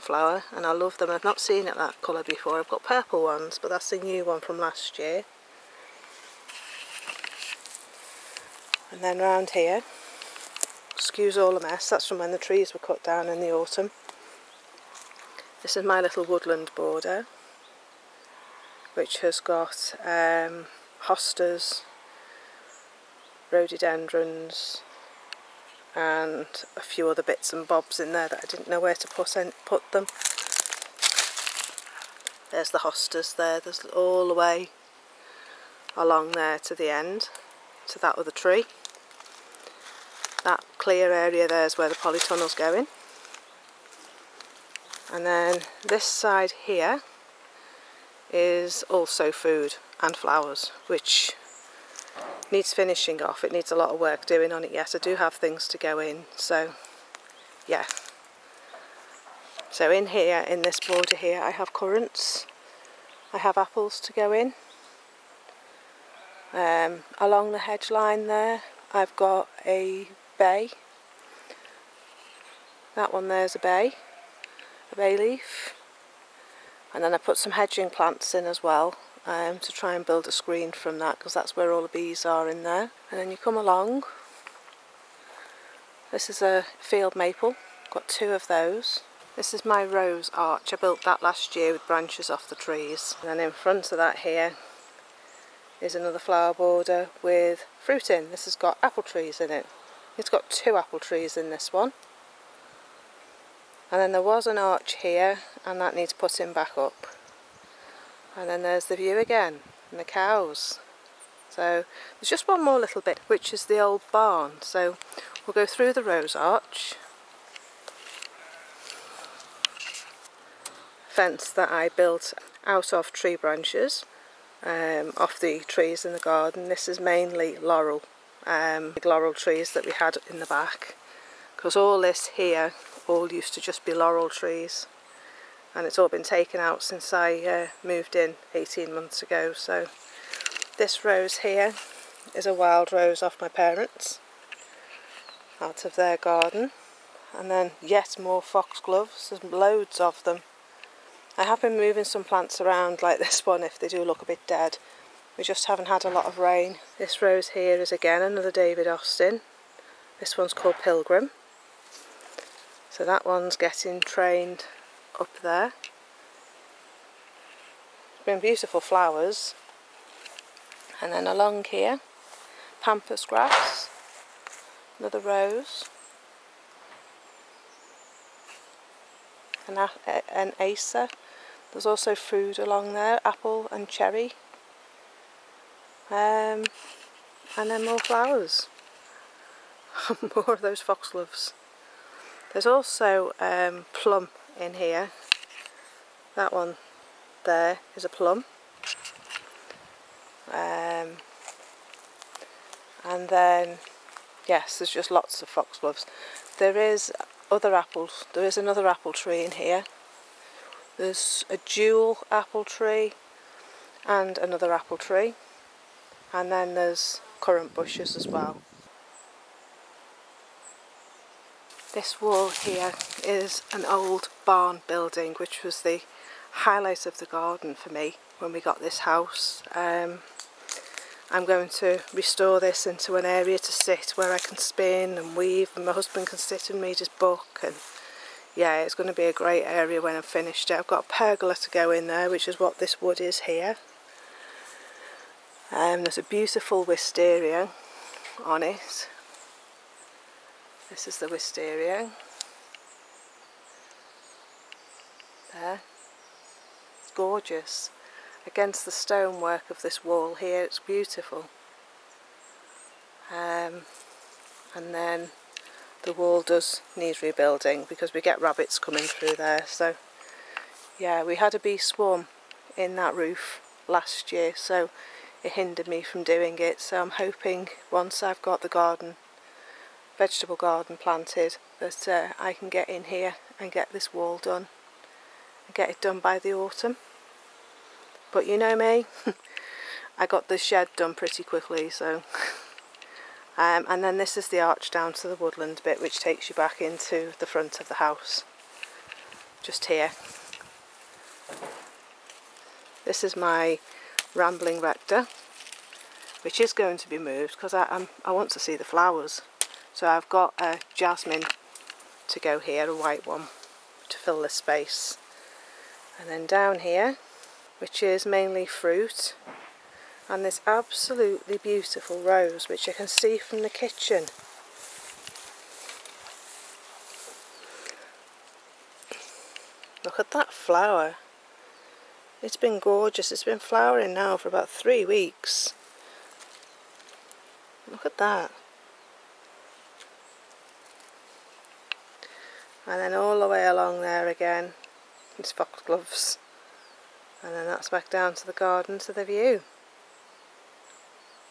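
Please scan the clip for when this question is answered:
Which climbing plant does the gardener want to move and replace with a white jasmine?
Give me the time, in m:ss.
5:04.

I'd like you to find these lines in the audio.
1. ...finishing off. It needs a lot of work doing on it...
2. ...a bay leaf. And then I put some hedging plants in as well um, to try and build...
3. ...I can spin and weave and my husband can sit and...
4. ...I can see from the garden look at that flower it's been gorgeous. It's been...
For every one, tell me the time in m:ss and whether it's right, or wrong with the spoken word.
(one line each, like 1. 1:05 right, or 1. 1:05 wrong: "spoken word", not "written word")
1. 0:52 right
2. 1:14 right
3. 3:54 right
4. 5:22 wrong: "kitchen", not "garden".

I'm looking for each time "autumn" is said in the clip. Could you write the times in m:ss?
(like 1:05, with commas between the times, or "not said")
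0:13, 4:46.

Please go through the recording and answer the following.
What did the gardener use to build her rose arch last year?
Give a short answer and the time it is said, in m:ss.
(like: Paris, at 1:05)
Branches off the trees, at 1:31.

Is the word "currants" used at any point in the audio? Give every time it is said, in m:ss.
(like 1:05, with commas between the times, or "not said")
1:01, 3:37.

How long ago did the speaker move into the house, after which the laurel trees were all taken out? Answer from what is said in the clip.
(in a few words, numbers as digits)
18 months.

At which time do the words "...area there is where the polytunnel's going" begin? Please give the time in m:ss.
0:41.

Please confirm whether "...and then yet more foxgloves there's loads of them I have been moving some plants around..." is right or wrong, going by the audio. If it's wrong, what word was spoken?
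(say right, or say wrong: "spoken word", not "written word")
right.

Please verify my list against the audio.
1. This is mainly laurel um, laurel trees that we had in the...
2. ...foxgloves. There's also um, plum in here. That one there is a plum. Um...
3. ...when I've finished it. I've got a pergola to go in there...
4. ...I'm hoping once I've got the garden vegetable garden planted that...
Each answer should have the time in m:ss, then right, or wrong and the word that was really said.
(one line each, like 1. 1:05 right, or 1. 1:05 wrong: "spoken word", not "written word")
1. 2:06 right
2. 3:10 right
3. 4:00 right
4. 4:37 right.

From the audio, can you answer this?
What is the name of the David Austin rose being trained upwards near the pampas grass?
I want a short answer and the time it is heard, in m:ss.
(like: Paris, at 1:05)
Pilgrim, at 2:40.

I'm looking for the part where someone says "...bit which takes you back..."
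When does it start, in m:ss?
4:55.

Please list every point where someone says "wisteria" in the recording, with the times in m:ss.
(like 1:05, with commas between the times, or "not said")
4:06, 4:11.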